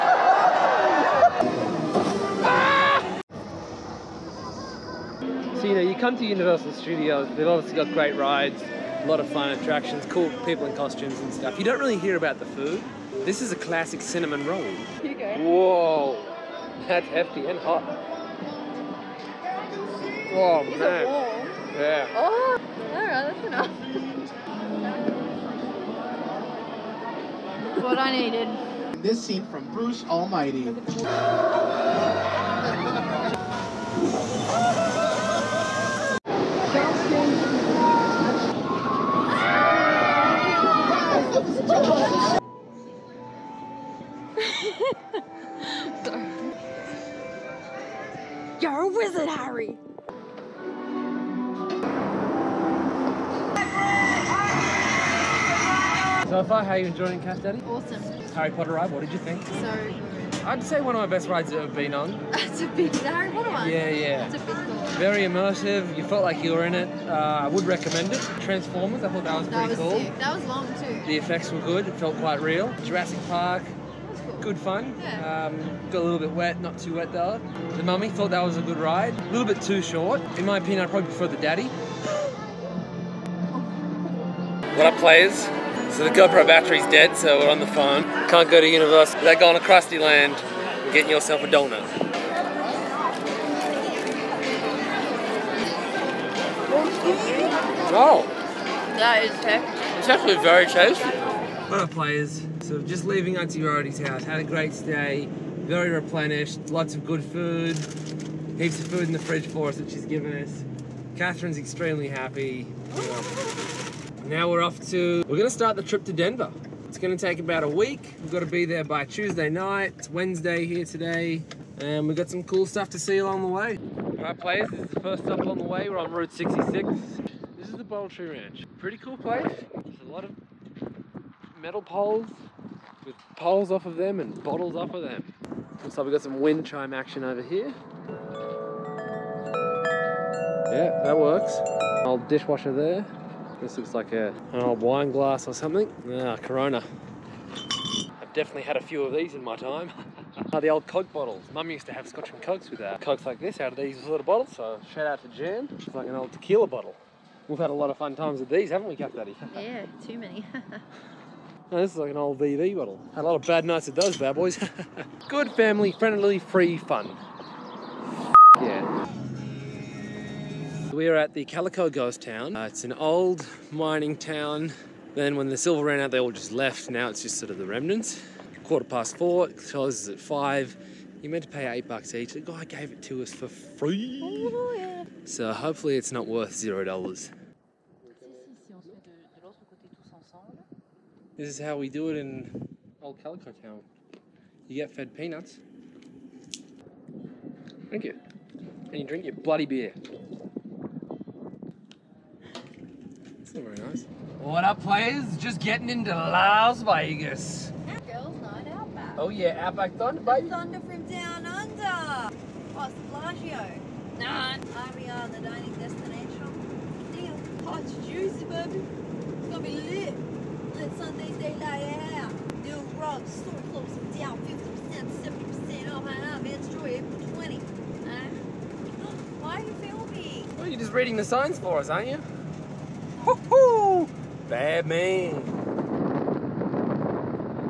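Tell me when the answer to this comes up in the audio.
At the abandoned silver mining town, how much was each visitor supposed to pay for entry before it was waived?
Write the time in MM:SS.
03:01.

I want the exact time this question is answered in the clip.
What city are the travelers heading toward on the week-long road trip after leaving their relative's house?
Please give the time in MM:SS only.
01:56.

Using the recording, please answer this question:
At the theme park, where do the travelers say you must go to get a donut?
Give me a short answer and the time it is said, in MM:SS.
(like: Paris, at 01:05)
Krusty Land, at 01:29.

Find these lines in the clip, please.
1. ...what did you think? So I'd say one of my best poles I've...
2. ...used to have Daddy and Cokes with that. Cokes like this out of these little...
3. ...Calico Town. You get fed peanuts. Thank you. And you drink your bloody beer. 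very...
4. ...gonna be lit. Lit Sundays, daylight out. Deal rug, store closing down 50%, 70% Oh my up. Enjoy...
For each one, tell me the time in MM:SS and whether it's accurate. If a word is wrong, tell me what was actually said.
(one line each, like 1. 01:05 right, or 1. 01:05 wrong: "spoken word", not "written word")
1. 00:58 wrong: "rides", not "poles"
2. 02:31 wrong: "Scotch", not "Daddy"
3. 03:13 right
4. 03:39 right.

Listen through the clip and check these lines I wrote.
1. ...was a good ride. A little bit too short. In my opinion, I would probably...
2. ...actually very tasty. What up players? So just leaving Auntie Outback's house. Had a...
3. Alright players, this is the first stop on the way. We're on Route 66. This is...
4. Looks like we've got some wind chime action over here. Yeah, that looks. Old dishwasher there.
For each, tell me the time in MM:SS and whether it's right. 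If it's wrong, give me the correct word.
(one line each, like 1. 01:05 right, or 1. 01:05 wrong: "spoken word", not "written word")
1. 01:18 right
2. 01:40 wrong: "Rarity", not "Outback"
3. 02:04 right
4. 02:15 wrong: "works", not "looks".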